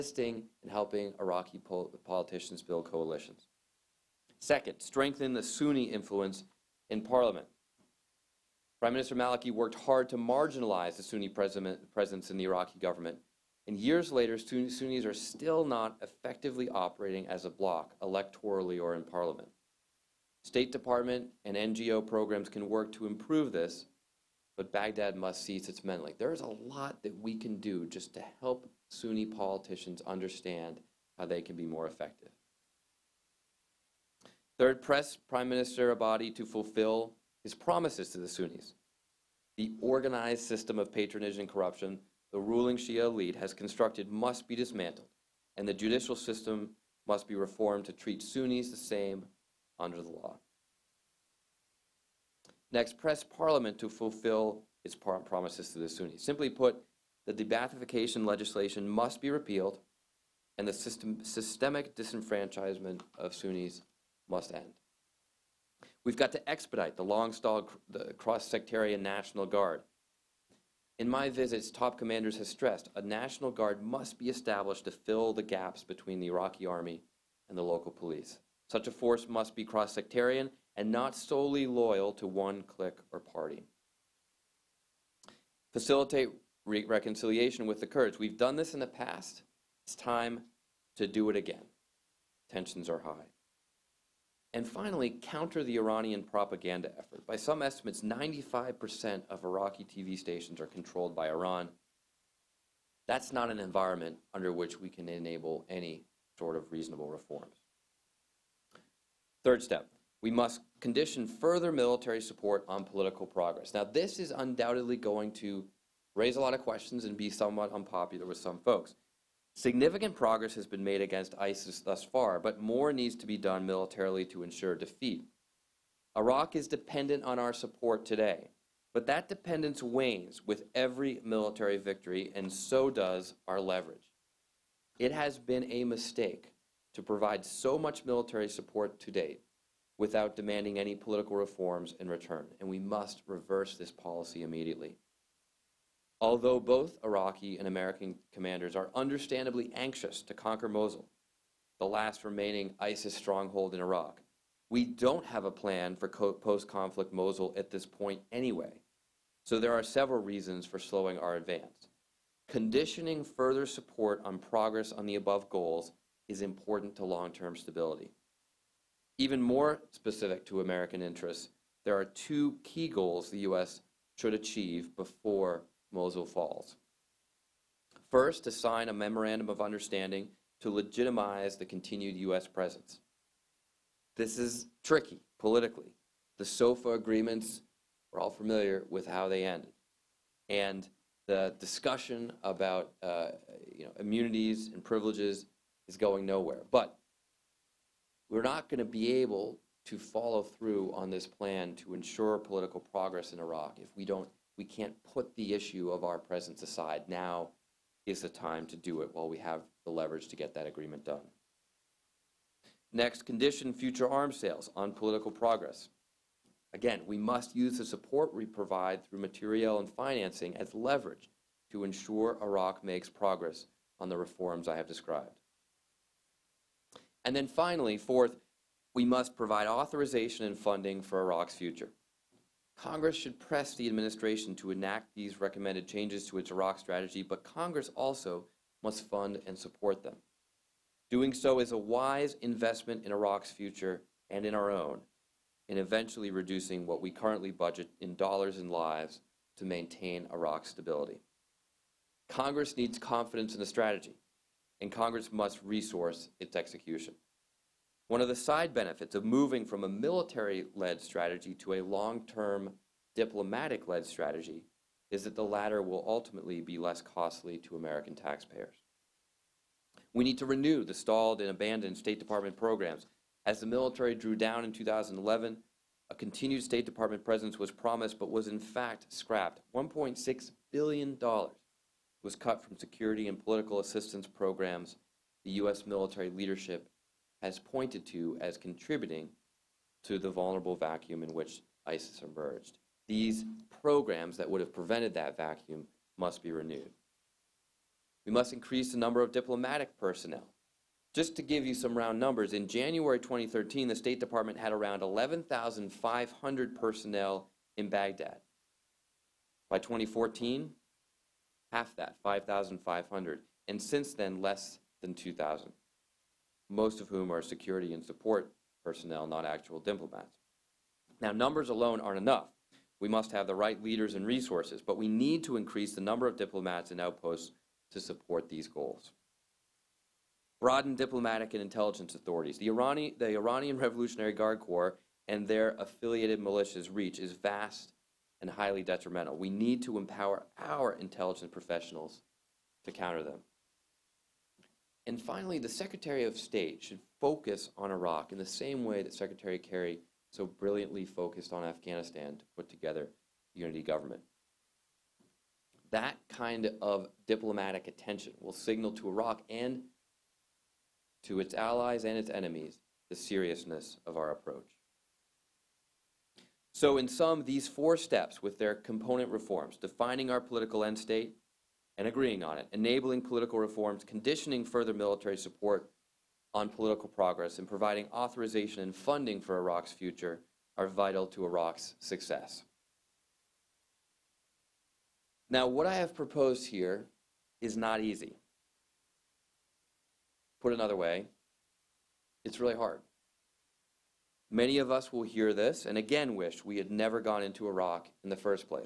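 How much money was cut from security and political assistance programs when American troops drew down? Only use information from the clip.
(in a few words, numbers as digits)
$1.6 billion.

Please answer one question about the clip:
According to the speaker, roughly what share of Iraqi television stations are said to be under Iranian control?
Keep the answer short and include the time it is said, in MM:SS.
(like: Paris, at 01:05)
95%, at 01:38.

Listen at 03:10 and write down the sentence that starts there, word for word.
And the discussion about uh, you know, immunities and privileges is going nowhere.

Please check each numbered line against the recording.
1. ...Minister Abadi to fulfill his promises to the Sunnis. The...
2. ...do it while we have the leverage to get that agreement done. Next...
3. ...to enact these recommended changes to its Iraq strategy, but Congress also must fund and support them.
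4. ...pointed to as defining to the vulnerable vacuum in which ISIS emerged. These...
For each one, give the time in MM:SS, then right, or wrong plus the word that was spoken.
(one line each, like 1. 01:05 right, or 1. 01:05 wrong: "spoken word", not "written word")
1. 00:35 right
2. 03:28 right
3. 03:54 right
4. 04:47 wrong: "contributing", not "defining".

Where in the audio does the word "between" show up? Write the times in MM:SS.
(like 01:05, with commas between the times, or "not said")
01:15.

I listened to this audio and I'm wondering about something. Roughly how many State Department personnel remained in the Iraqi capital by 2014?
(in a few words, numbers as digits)
5,500.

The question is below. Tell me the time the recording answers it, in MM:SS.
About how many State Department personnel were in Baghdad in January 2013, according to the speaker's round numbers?
05:05.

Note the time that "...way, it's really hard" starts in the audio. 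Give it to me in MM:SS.
06:30.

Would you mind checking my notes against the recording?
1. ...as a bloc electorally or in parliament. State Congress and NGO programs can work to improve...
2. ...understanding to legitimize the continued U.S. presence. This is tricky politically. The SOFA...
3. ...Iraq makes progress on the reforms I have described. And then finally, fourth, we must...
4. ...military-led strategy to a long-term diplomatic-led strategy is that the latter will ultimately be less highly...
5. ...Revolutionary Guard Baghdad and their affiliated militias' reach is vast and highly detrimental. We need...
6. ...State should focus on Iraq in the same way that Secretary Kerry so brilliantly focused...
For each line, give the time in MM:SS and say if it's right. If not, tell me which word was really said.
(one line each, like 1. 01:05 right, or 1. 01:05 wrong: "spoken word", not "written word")
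1. 00:17 wrong: "Department", not "Congress"
2. 02:59 right
3. 03:42 right
4. 04:19 wrong: "costly", not "highly"
5. 05:33 wrong: "Corps", not "Baghdad"
6. 05:46 right.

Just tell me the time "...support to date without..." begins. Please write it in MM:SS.
02:18.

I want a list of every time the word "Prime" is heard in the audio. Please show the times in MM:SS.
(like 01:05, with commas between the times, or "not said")
00:08, 00:35.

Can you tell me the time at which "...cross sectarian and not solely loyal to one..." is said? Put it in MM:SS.
01:19.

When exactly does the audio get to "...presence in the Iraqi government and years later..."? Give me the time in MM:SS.
00:11.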